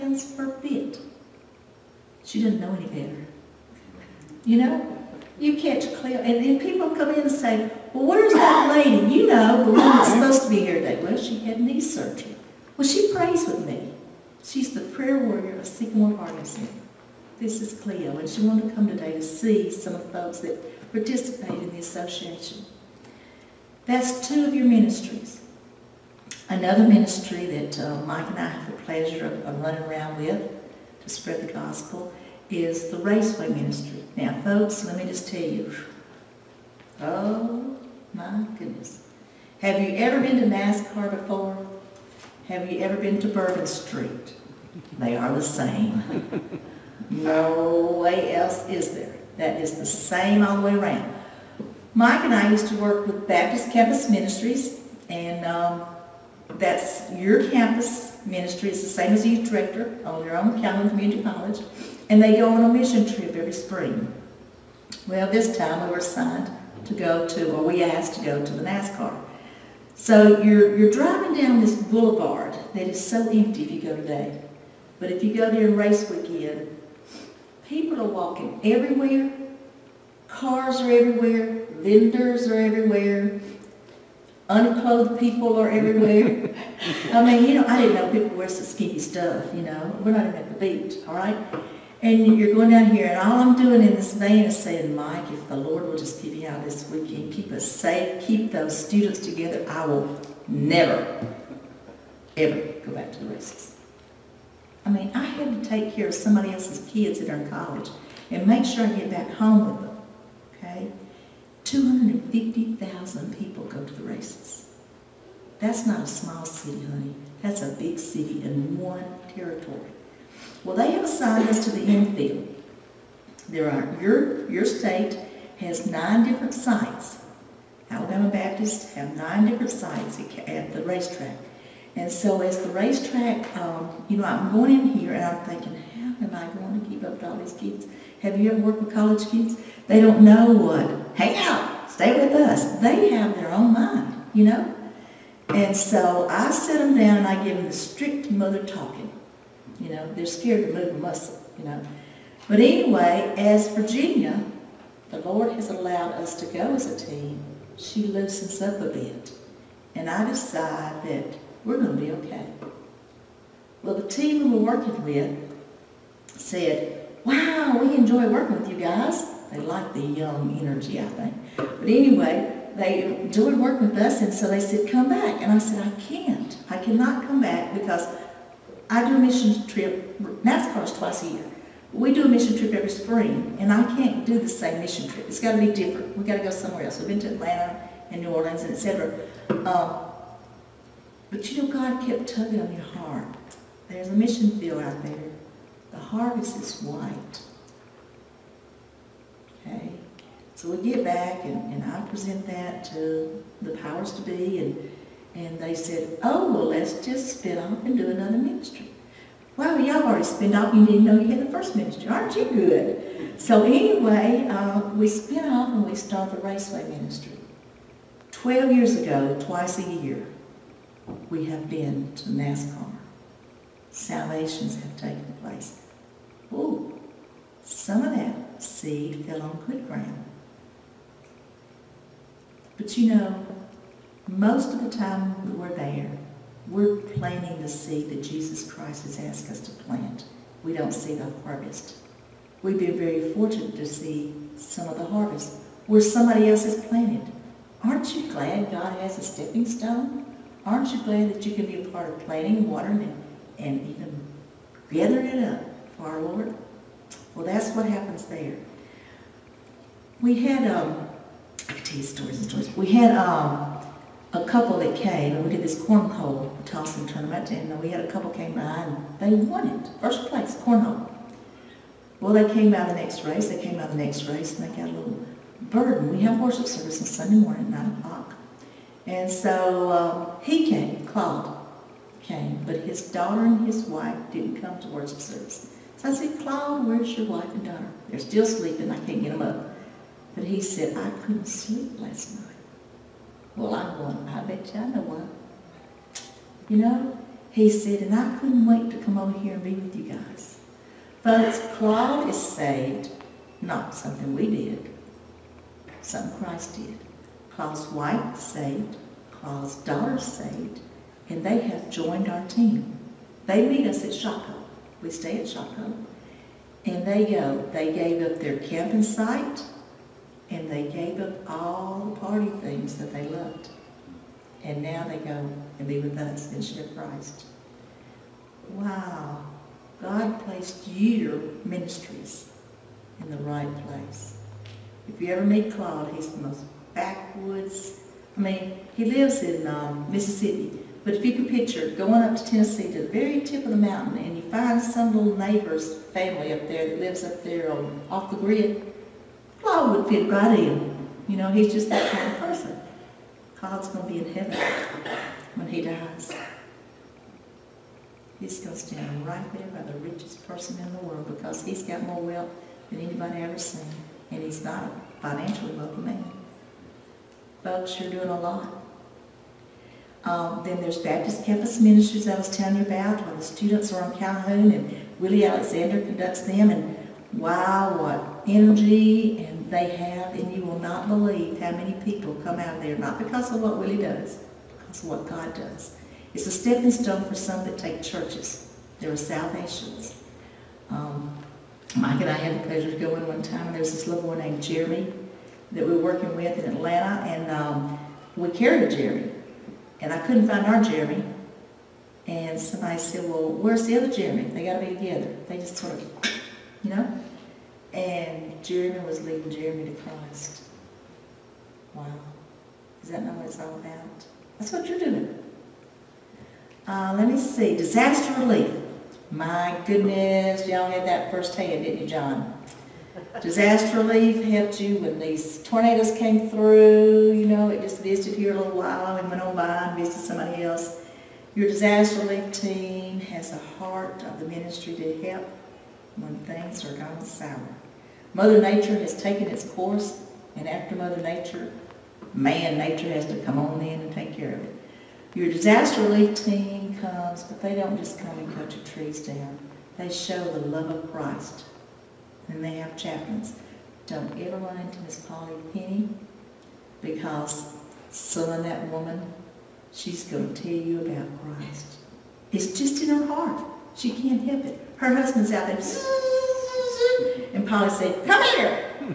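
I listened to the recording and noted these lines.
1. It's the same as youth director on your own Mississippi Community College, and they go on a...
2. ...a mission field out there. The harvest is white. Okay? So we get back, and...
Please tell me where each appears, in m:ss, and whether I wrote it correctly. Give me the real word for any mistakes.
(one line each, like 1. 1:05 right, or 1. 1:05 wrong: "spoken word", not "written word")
1. 0:58 wrong: "Calhoun", not "Mississippi"
2. 3:14 right.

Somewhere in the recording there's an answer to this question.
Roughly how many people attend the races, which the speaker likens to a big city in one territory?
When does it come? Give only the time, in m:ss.
1:51.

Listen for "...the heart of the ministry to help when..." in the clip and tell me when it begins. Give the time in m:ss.
7:13.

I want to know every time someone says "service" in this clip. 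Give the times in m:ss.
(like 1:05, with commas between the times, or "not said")
4:36, 4:45.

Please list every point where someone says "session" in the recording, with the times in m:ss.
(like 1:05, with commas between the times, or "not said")
not said.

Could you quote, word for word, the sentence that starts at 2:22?
They have their own mind, you know?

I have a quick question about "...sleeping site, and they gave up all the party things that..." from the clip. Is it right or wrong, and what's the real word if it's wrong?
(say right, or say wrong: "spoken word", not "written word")
wrong: "camping", not "sleeping".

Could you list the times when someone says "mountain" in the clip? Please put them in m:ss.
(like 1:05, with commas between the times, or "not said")
5:43.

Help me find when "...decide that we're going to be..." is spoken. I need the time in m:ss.
2:40.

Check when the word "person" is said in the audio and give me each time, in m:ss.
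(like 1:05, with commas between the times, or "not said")
5:52, 6:00.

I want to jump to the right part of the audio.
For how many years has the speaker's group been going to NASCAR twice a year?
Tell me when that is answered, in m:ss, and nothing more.
3:38.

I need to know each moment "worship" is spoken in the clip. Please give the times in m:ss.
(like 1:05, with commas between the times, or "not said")
4:36, 4:44.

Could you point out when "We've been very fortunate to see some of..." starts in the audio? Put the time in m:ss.
4:02.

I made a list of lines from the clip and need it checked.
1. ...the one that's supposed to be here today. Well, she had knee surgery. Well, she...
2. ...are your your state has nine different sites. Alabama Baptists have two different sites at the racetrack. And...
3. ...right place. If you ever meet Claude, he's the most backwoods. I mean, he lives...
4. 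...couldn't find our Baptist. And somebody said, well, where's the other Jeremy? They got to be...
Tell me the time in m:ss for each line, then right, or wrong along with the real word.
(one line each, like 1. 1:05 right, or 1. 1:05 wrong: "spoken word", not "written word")
1. 0:09 right
2. 2:03 wrong: "nine", not "two"
3. 5:33 right
4. 6:40 wrong: "Jeremy", not "Baptist".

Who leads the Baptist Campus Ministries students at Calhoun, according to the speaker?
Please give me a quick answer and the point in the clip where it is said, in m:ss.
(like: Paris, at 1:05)
Willie Alexander, at 6:15.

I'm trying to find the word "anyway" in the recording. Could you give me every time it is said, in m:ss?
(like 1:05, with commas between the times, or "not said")
2:32, 2:51, 3:33.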